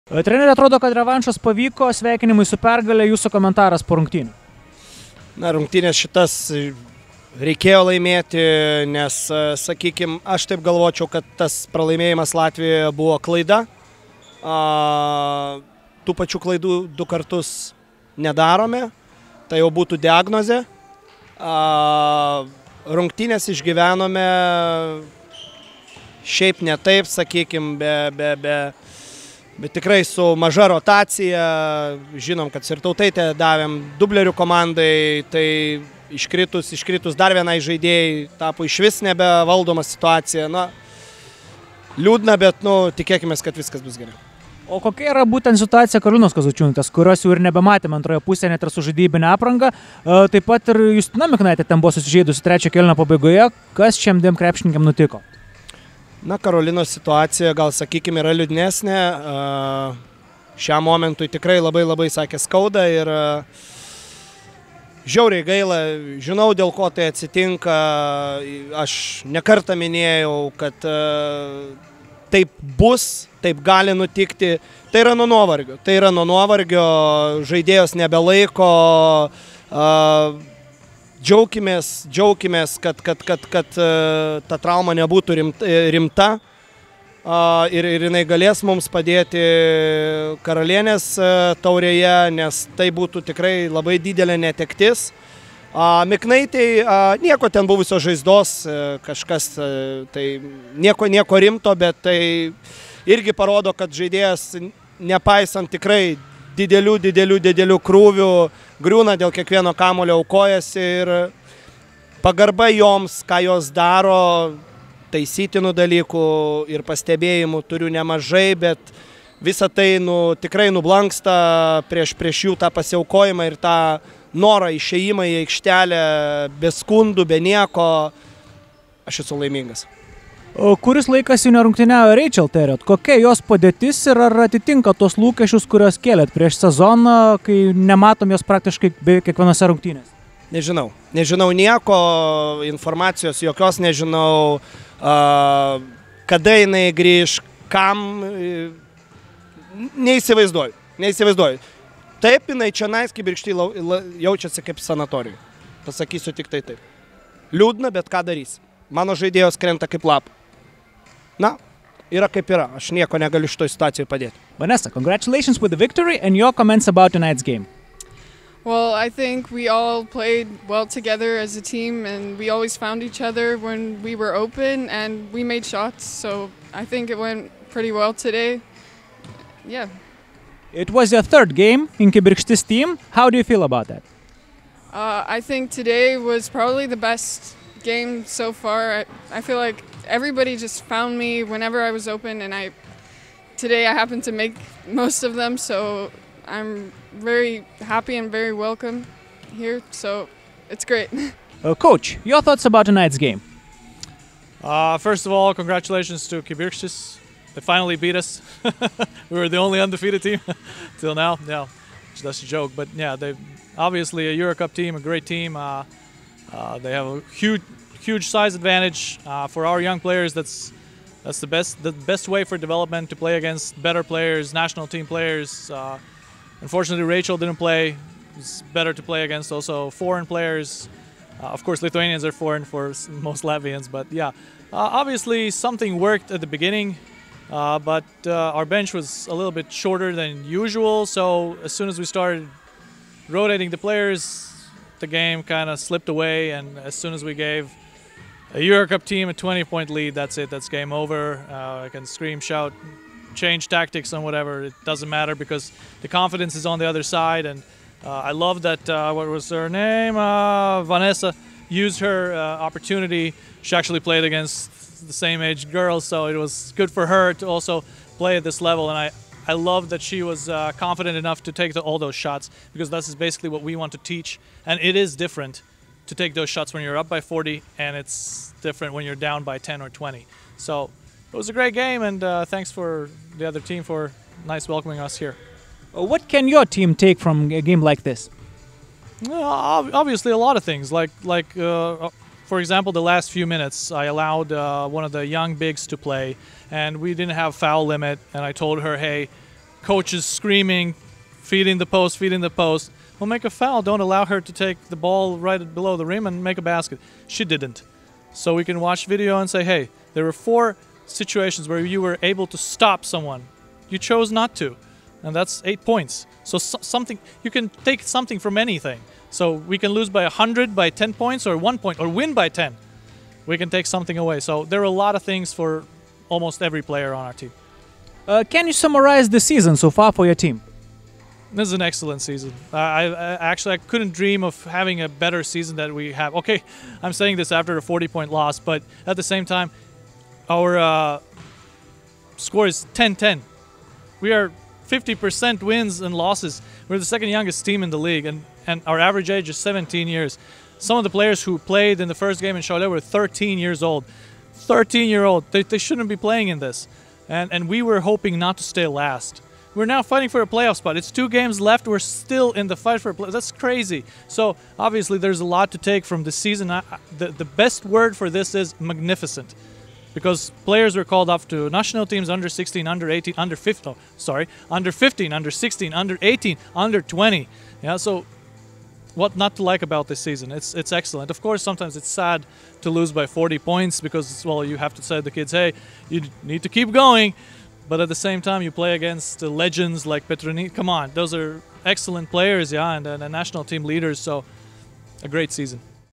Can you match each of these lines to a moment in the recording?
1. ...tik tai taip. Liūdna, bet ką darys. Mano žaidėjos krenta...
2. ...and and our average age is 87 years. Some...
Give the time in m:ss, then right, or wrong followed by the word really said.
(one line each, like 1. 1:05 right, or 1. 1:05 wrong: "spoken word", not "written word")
1. 2:36 right
2. 5:48 wrong: "17", not "87".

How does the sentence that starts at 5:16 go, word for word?
So, something you can take something from anything.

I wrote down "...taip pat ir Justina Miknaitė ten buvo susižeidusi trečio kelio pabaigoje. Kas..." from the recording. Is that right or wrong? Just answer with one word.
right.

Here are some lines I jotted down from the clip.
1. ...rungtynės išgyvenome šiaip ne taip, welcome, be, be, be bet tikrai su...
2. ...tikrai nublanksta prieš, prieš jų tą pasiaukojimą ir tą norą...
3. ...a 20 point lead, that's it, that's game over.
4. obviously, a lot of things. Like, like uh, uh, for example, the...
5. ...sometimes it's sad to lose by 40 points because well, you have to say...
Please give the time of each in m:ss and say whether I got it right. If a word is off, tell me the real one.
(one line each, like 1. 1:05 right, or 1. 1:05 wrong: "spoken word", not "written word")
1. 0:22 wrong: "sakykime", not "welcome"
2. 2:00 right
3. 4:09 right
4. 4:49 right
5. 6:21 right.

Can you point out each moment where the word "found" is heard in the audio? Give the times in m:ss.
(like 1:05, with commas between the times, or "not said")
2:52, 3:10.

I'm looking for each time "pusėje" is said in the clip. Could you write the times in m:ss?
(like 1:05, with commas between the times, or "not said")
0:48.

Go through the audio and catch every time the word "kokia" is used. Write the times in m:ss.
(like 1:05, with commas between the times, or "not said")
0:44, 2:12.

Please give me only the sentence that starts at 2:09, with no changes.
Aš esu laimingas kuris laikas jau nerungtyniavo Rachel Terriot.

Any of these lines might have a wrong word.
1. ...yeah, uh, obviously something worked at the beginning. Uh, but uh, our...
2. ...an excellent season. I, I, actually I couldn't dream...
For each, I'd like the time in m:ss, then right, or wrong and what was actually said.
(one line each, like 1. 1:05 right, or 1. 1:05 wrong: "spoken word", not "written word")
1. 3:54 right
2. 5:31 right.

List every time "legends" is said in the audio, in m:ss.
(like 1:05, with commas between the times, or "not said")
6:29.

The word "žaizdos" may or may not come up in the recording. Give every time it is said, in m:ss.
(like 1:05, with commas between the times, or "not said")
1:38.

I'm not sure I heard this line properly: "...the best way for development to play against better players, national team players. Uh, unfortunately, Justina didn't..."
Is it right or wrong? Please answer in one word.
wrong.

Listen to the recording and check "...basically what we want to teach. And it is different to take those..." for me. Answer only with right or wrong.
right.